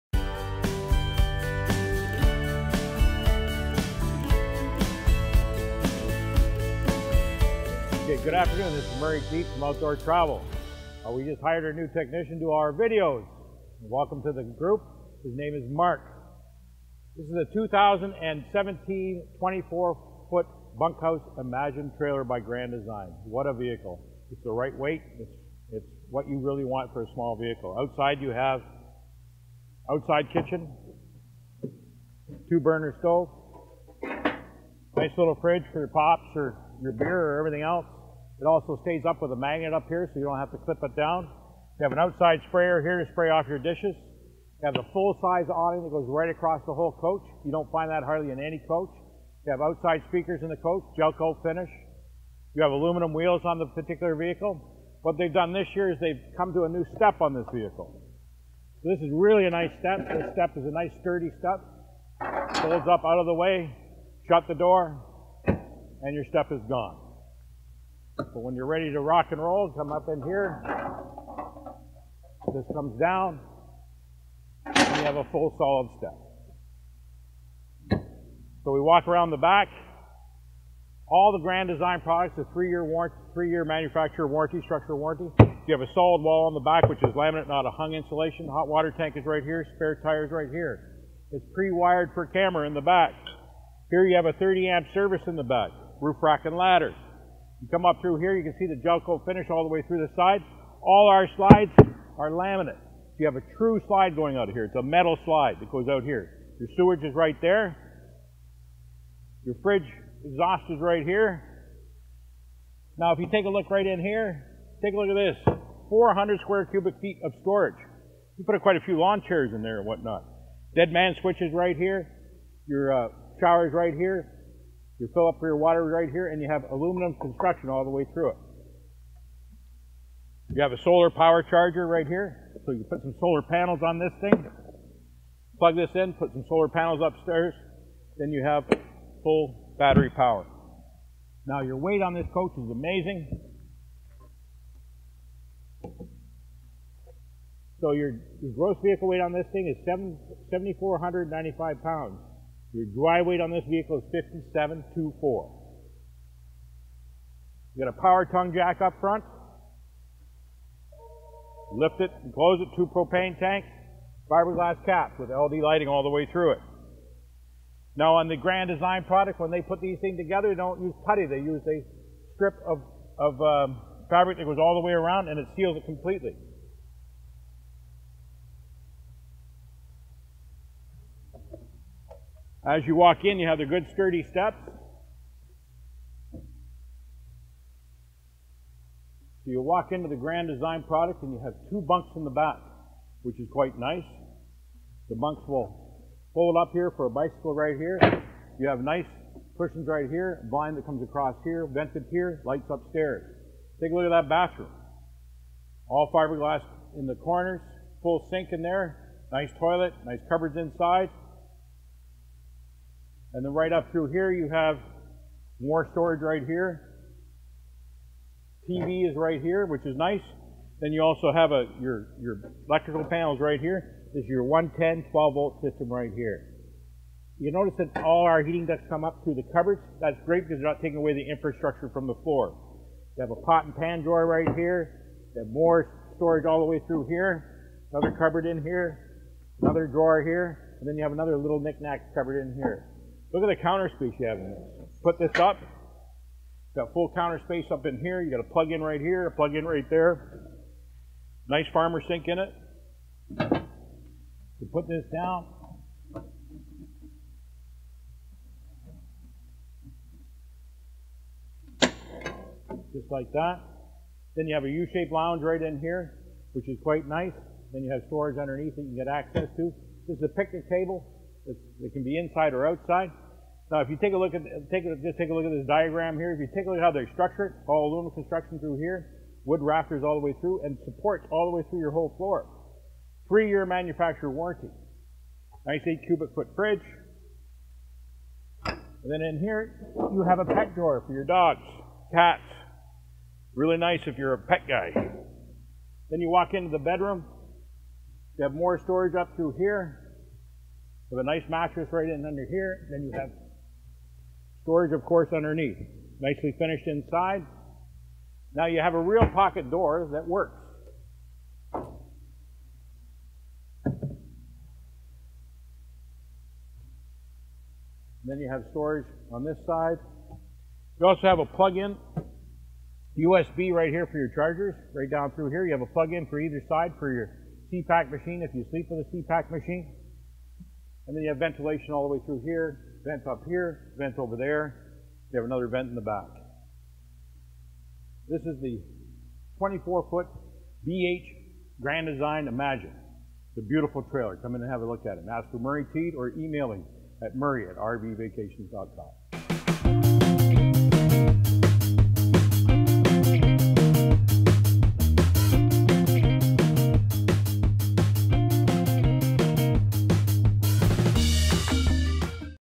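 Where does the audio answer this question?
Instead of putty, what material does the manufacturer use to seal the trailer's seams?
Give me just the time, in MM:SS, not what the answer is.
02:54.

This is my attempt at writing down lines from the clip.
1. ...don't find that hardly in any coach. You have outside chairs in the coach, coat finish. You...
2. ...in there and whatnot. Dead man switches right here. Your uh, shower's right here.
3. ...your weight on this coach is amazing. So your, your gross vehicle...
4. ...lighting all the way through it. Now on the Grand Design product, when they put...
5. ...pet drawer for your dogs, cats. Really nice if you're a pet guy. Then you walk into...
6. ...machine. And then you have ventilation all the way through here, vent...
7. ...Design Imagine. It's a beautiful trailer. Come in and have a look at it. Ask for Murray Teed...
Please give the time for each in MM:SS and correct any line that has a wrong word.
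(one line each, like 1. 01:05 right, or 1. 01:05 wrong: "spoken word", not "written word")
1. 00:47 wrong: "speakers", not "chairs"
2. 01:59 right
3. 02:21 right
4. 02:45 right
5. 04:50 right
6. 05:29 right
7. 05:42 right.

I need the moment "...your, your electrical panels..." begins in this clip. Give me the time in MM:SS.
03:41.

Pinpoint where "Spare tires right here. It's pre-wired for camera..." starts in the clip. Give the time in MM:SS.
01:29.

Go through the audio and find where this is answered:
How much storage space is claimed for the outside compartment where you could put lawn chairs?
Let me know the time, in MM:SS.
01:55.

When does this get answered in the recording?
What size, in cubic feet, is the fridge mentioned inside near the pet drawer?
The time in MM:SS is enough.
04:45.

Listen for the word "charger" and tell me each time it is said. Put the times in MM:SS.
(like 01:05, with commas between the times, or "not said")
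02:11, 05:24.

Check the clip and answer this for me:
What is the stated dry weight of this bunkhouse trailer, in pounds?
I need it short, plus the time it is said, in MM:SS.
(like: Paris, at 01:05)
5724, at 02:34.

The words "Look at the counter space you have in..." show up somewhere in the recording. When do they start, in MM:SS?
04:03.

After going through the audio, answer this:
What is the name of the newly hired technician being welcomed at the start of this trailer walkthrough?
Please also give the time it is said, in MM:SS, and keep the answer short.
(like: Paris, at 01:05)
Mark, at 00:15.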